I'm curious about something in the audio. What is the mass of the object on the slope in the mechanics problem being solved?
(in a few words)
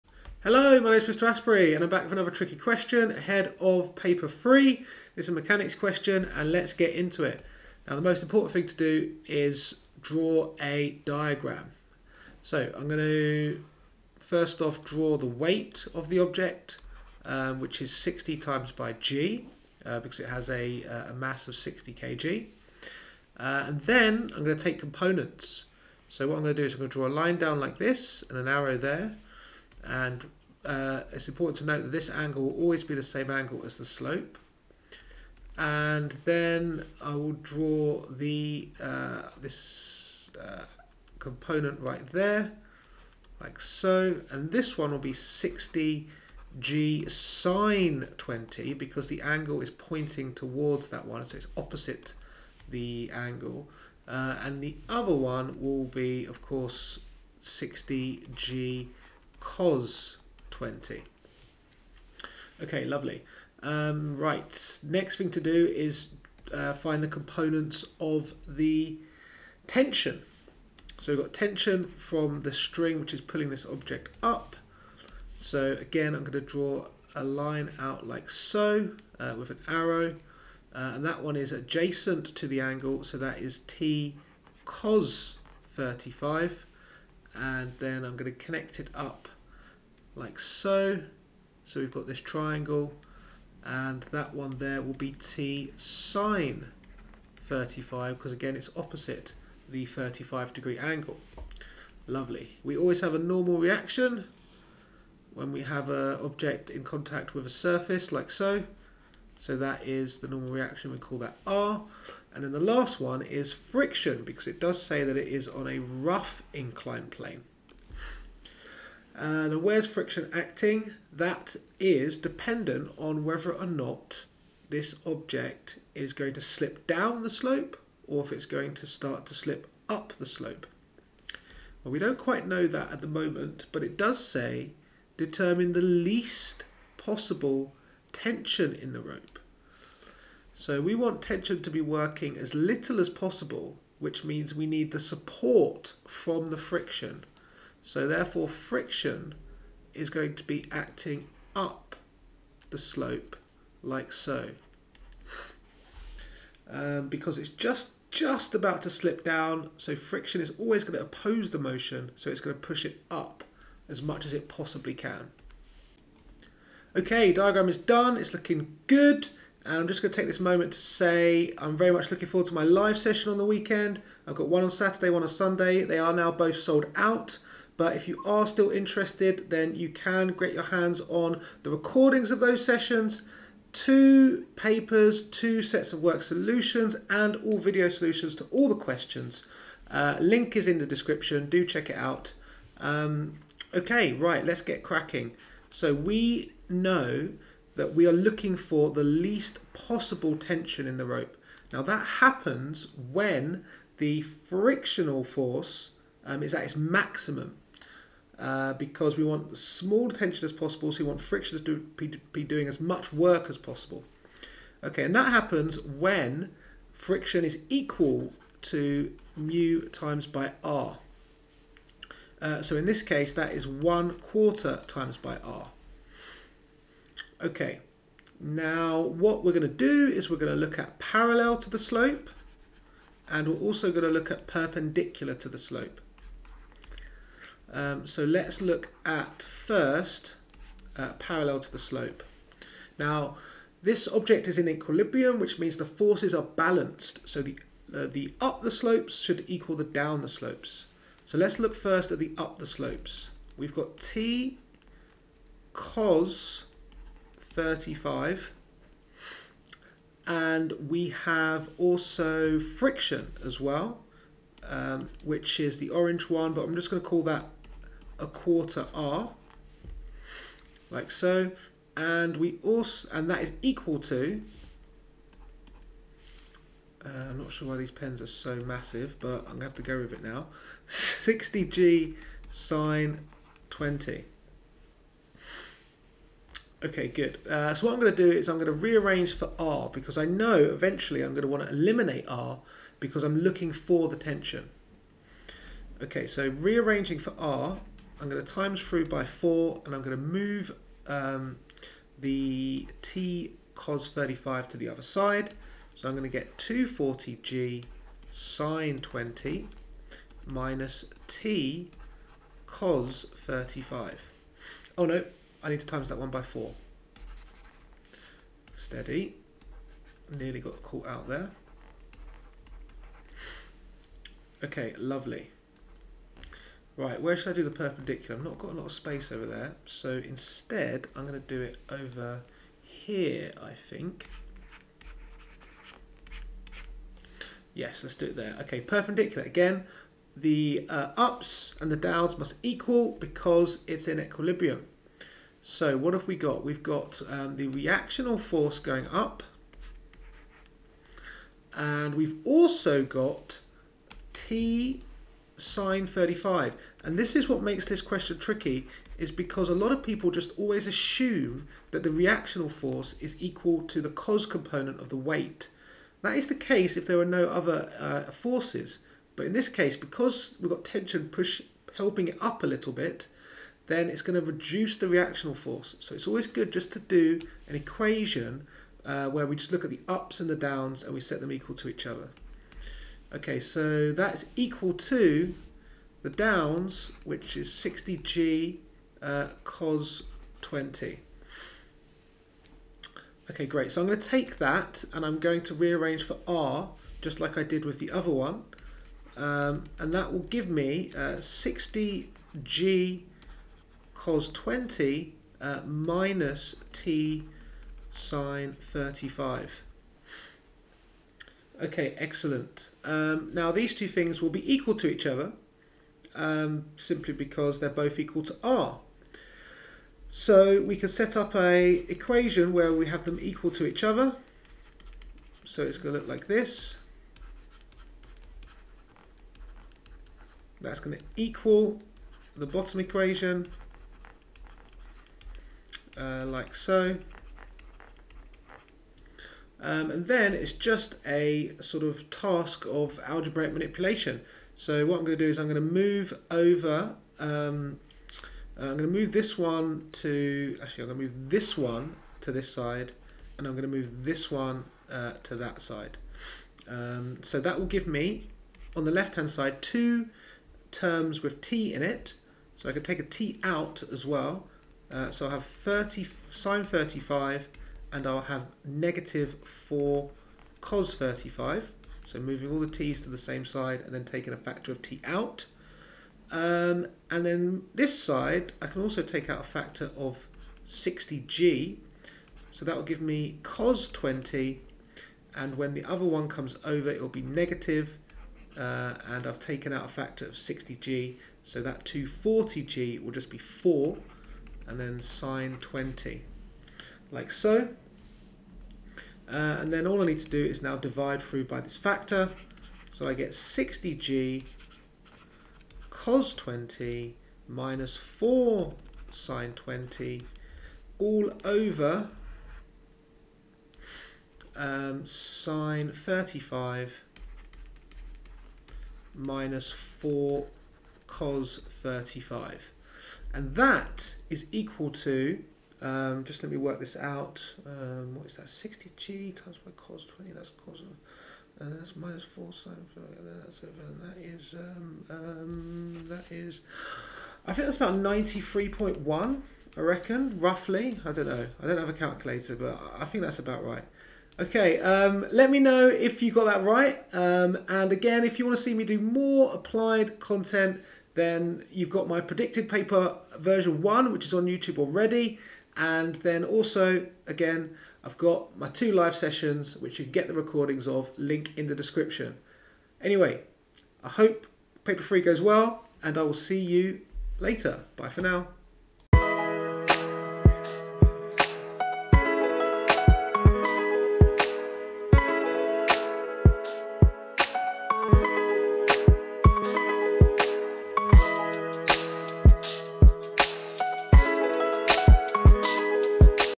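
60 kg.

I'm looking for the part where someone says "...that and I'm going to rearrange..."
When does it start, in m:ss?
6:34.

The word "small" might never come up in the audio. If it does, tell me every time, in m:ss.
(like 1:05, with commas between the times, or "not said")
3:29.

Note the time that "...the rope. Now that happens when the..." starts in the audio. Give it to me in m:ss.
3:20.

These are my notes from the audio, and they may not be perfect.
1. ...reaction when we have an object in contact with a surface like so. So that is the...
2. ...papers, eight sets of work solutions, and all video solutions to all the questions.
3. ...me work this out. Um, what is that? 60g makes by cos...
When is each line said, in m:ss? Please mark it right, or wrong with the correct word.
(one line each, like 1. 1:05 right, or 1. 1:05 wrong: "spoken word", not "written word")
1. 1:43 right
2. 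3:04 wrong: "two", not "eight"
3. 8:46 wrong: "times", not "makes".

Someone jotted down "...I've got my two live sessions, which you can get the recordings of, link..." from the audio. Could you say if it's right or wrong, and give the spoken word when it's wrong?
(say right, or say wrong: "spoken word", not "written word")
right.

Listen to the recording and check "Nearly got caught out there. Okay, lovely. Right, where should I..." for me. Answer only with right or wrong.
right.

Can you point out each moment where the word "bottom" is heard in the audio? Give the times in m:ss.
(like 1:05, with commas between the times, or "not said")
7:12.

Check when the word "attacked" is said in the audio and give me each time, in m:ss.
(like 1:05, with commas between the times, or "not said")
not said.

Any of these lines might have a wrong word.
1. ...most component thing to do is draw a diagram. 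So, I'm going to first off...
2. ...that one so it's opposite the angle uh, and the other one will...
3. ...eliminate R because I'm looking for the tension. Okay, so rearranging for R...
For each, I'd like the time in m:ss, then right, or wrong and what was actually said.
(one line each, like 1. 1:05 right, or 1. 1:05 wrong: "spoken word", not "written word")
1. 0:08 wrong: "important", not "component"
2. 0:50 right
3. 4:51 right.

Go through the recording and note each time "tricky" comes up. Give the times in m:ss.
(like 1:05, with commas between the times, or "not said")
0:02, 5:58.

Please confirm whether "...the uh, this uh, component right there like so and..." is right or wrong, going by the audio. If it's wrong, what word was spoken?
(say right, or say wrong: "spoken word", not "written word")
right.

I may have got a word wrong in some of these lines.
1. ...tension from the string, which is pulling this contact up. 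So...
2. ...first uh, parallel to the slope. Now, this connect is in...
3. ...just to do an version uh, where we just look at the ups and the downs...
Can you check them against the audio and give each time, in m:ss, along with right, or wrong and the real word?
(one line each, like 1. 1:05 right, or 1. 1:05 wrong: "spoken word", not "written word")
1. 1:11 wrong: "object", not "contact"
2. 3:59 wrong: "object", not "connect"
3. 6:16 wrong: "equation", not "version".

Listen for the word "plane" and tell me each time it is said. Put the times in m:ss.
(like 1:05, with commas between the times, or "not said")
1:57.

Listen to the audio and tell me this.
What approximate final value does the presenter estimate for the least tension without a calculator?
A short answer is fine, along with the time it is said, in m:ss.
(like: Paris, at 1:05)
93.1, at 8:58.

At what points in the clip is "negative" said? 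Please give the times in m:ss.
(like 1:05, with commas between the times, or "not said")
7:48, 8:07.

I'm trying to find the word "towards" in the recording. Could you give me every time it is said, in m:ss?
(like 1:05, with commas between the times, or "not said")
0:50.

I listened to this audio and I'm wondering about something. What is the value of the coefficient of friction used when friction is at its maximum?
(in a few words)
1/4.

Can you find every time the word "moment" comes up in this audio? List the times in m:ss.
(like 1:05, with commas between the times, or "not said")
2:13, 2:50.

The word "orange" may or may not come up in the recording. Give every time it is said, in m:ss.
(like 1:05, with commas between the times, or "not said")
4:25.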